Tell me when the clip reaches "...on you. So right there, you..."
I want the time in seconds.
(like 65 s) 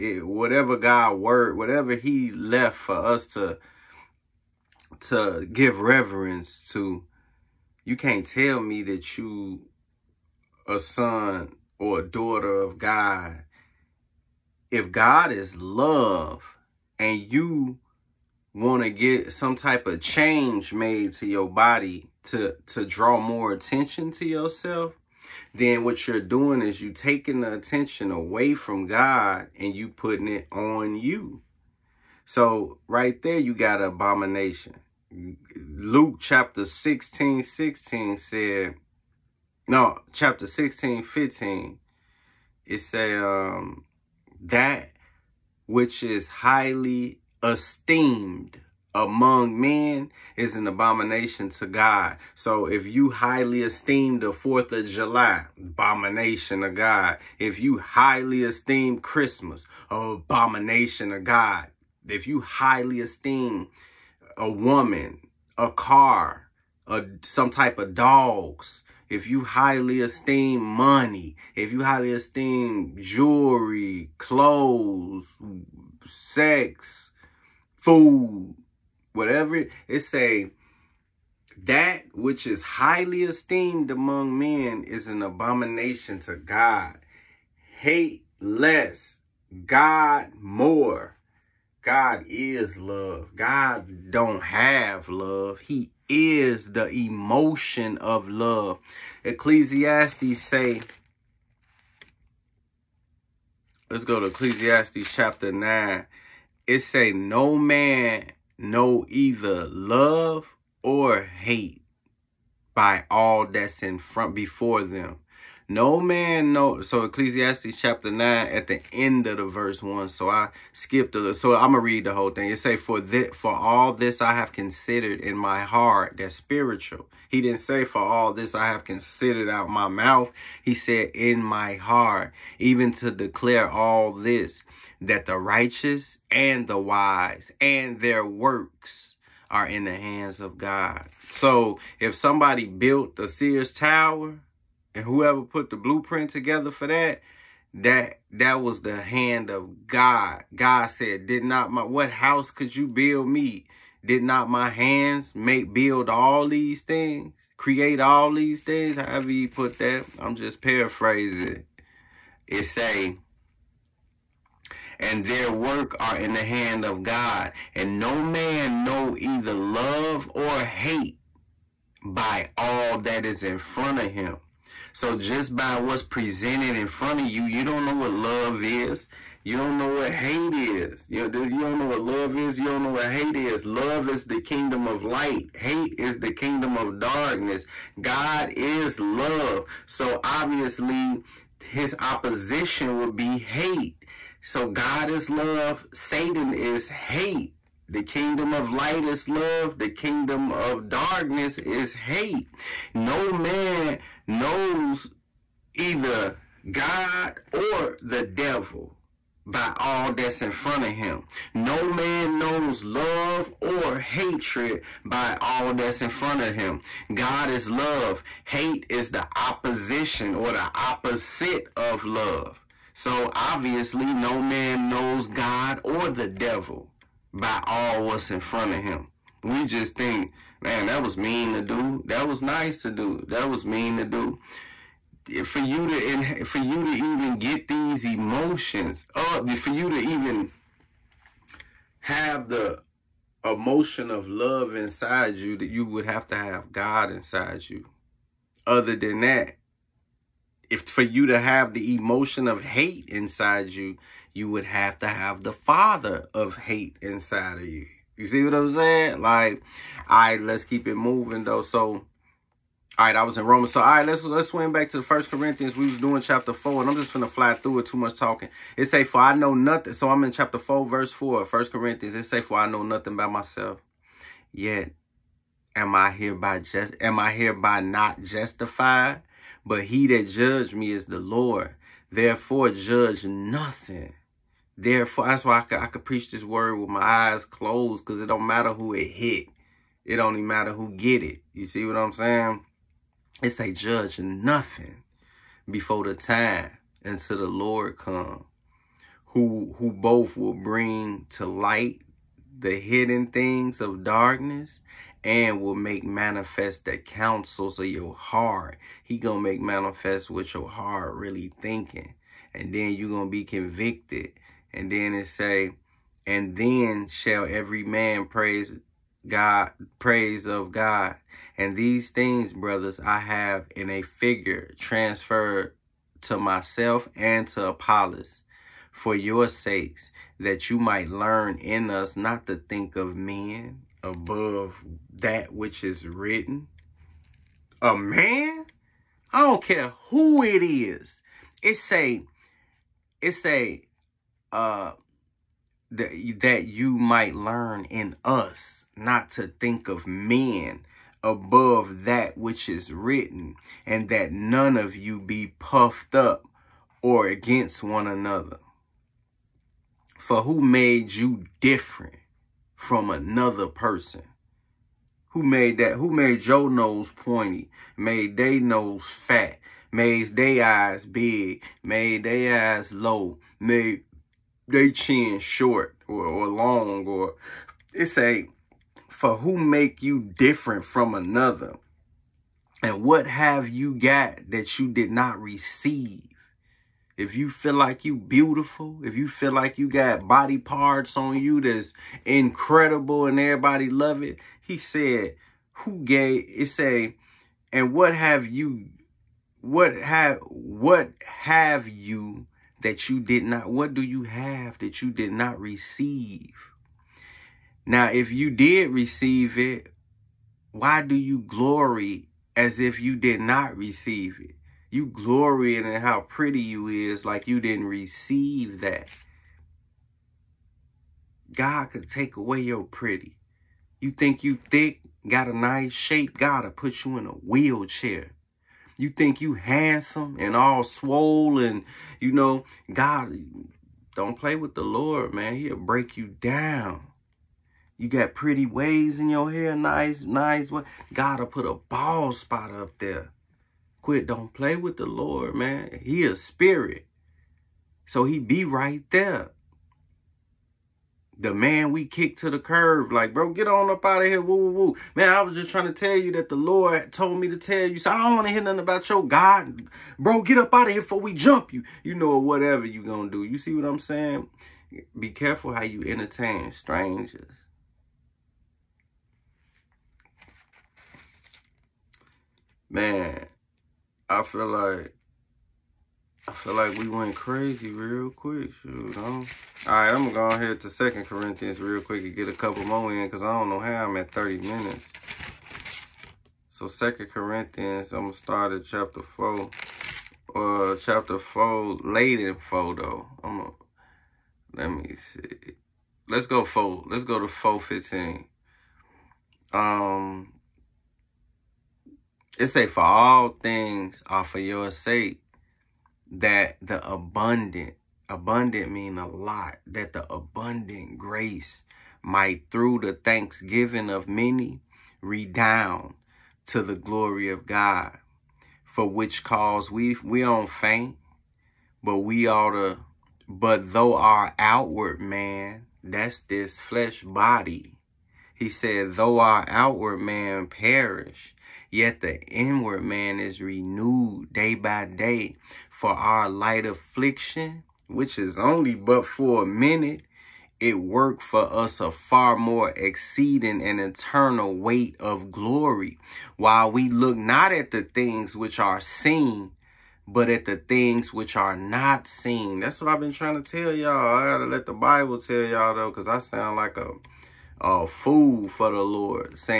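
30 s.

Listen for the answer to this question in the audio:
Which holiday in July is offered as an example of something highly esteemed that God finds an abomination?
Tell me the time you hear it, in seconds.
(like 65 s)
54 s.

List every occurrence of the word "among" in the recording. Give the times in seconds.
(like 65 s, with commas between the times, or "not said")
48 s, 83 s.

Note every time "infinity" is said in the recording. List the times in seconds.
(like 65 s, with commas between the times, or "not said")
not said.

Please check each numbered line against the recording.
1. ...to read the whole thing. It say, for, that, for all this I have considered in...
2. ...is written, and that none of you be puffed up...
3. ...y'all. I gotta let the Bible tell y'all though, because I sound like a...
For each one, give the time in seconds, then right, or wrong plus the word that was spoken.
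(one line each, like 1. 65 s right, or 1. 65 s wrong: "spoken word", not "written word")
1. 121 s right
2. 352 s right
3. 553 s right.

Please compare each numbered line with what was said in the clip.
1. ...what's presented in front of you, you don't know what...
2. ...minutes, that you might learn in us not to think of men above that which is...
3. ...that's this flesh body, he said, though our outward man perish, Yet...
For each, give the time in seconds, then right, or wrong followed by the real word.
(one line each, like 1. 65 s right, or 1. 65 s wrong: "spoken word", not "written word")
1. 175 s right
2. 329 s wrong: "sakes", not "minutes"
3. 526 s right.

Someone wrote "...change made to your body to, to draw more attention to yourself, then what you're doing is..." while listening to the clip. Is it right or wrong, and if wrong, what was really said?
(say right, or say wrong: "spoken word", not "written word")
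right.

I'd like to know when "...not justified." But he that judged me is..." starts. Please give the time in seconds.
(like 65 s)
277 s.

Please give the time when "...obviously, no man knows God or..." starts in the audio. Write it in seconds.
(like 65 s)
223 s.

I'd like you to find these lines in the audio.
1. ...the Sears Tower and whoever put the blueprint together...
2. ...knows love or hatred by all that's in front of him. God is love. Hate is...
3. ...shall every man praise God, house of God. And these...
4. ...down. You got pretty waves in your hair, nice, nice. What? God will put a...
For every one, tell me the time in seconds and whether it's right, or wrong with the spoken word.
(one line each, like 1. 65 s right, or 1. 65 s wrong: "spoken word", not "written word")
1. 143 s right
2. 212 s right
3. 317 s wrong: "praise", not "house"
4. 436 s right.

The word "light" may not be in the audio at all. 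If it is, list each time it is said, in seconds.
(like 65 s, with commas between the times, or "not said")
185 s, 198 s, 301 s, 536 s.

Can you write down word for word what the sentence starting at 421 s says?
God could take away your pretty.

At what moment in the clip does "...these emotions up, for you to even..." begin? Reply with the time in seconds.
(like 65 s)
237 s.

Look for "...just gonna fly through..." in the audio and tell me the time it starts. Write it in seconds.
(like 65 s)
266 s.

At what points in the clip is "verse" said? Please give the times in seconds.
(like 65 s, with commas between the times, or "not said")
119 s, 270 s.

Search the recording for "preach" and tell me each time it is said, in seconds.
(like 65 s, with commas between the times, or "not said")
286 s.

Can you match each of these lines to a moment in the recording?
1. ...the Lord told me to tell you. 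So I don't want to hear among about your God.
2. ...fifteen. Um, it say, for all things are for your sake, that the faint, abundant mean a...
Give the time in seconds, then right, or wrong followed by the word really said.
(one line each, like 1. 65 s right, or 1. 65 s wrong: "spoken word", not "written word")
1. 456 s wrong: "nothing", not "among"
2. 497 s wrong: "abundant", not "faint".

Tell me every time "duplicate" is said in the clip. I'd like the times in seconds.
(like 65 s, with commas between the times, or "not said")
not said.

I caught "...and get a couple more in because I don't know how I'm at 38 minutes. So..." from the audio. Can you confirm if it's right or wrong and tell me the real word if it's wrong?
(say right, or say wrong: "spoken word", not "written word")
wrong: "30", not "38".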